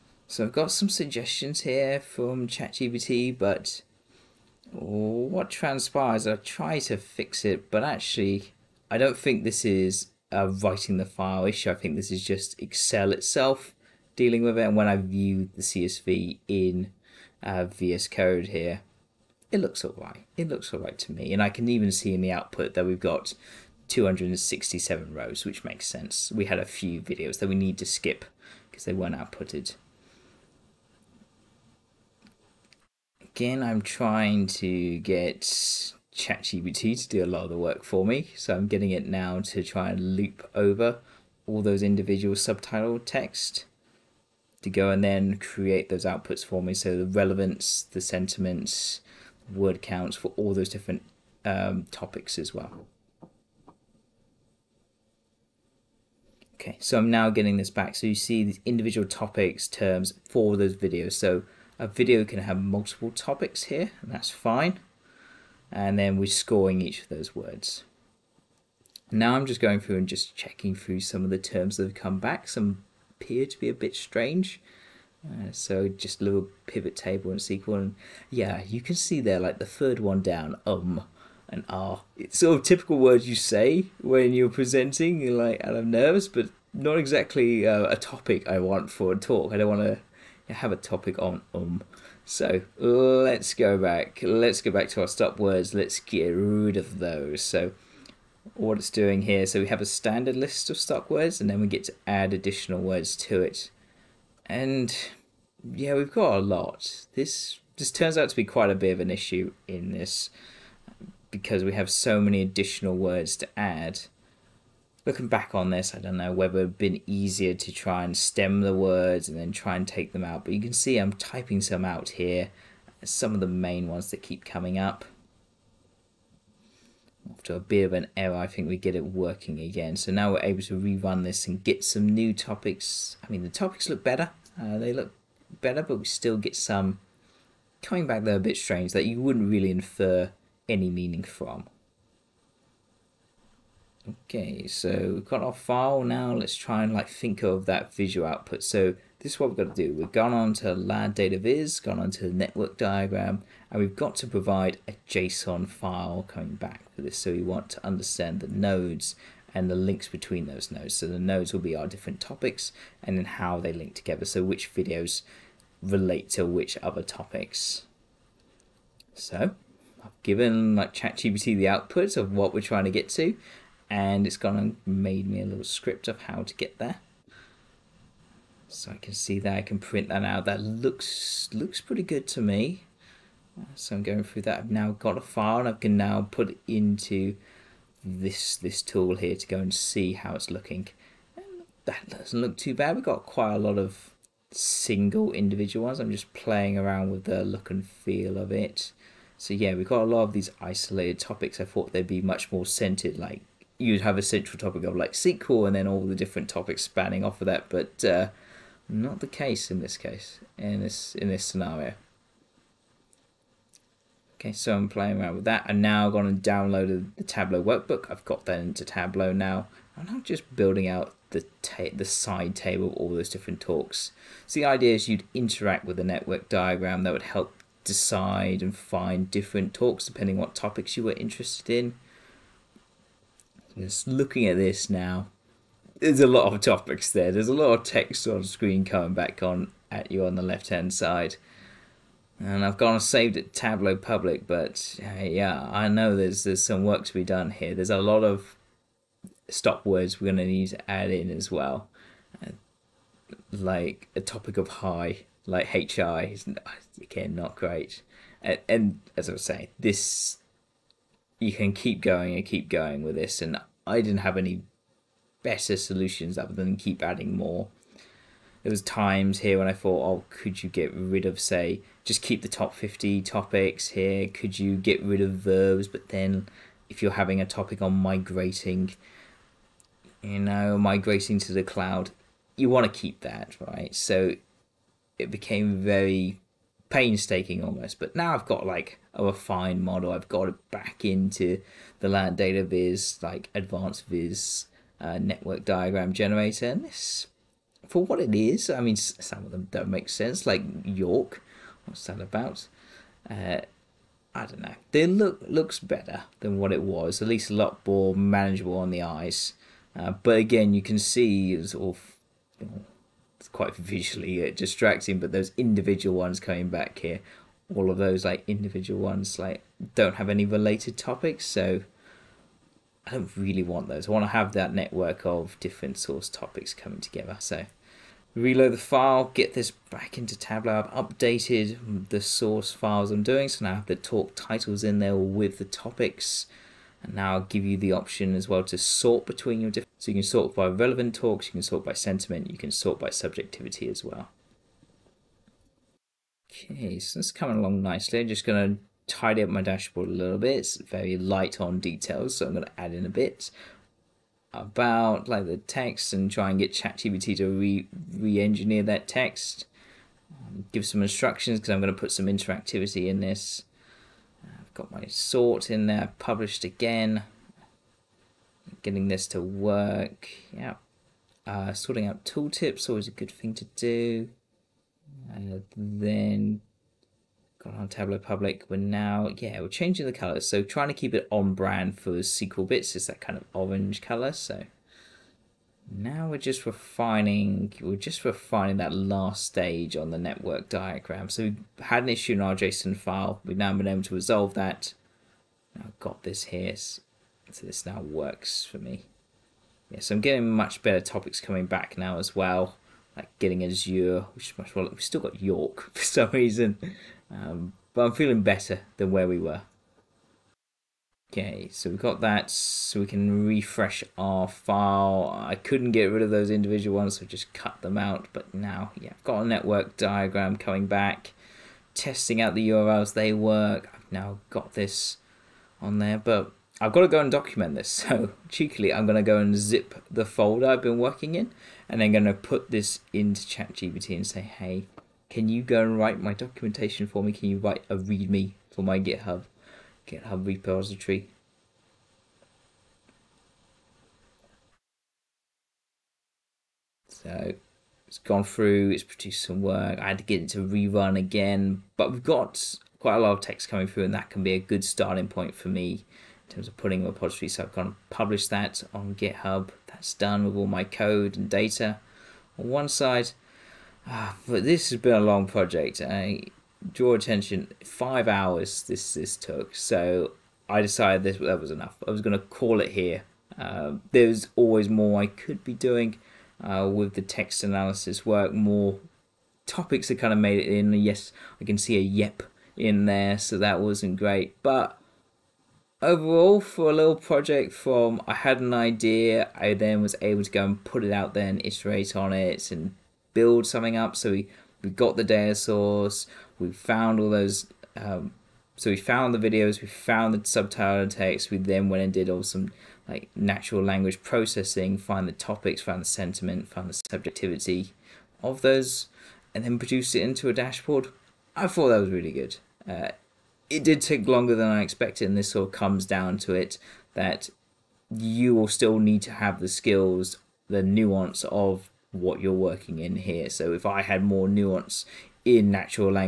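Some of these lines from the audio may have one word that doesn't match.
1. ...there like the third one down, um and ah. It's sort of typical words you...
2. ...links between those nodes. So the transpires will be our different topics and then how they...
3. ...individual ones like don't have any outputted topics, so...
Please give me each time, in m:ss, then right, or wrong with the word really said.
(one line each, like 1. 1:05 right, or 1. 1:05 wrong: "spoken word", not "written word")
1. 1:19 right
2. 2:39 wrong: "nodes", not "transpires"
3. 5:18 wrong: "related", not "outputted".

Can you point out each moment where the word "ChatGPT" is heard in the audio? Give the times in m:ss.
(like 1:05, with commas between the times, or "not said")
0:02, 0:36, 2:50, 5:56, 7:13.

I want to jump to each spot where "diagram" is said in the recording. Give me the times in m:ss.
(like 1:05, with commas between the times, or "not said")
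2:32, 3:46, 4:55, 6:30, 6:59.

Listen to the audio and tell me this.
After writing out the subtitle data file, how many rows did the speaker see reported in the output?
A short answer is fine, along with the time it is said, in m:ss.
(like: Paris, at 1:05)
267, at 0:23.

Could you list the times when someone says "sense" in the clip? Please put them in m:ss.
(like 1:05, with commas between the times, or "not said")
0:25, 5:00.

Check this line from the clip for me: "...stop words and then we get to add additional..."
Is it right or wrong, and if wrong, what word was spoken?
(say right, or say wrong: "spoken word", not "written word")
right.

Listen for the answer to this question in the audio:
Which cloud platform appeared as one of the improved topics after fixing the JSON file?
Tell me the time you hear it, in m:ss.
6:43.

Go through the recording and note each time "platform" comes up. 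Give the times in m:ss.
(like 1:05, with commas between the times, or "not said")
not said.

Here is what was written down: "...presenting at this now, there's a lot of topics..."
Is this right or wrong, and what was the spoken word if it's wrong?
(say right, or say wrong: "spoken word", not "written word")
wrong: "looking", not "presenting".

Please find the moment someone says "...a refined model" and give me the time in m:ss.
4:49.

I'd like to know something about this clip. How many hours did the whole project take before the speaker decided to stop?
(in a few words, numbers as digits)
5.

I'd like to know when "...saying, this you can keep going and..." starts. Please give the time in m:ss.
4:19.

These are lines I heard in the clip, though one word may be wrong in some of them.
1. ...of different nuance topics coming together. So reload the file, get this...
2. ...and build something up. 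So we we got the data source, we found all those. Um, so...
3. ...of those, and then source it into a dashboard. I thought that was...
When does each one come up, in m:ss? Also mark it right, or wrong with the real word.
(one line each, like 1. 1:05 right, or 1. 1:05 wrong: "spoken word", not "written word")
1. 5:25 wrong: "source", not "nuance"
2. 8:12 right
3. 8:28 wrong: "produce", not "source".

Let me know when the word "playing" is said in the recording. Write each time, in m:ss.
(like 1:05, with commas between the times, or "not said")
3:16, 3:34.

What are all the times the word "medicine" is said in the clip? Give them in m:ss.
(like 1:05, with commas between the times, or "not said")
not said.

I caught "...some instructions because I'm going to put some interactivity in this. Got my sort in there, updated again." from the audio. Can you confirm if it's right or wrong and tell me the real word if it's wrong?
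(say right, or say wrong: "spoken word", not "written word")
wrong: "published", not "updated".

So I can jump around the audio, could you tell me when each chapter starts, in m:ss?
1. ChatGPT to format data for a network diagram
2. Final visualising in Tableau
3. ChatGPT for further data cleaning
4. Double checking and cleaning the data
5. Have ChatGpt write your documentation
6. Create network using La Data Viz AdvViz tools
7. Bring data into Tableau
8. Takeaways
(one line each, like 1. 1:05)
1. 2:24
2. 5:59
3. 4:08
4. 0:14
5. 7:17
6. 3:10
7. 3:39
8. 7:37.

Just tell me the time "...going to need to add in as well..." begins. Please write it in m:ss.
4:10.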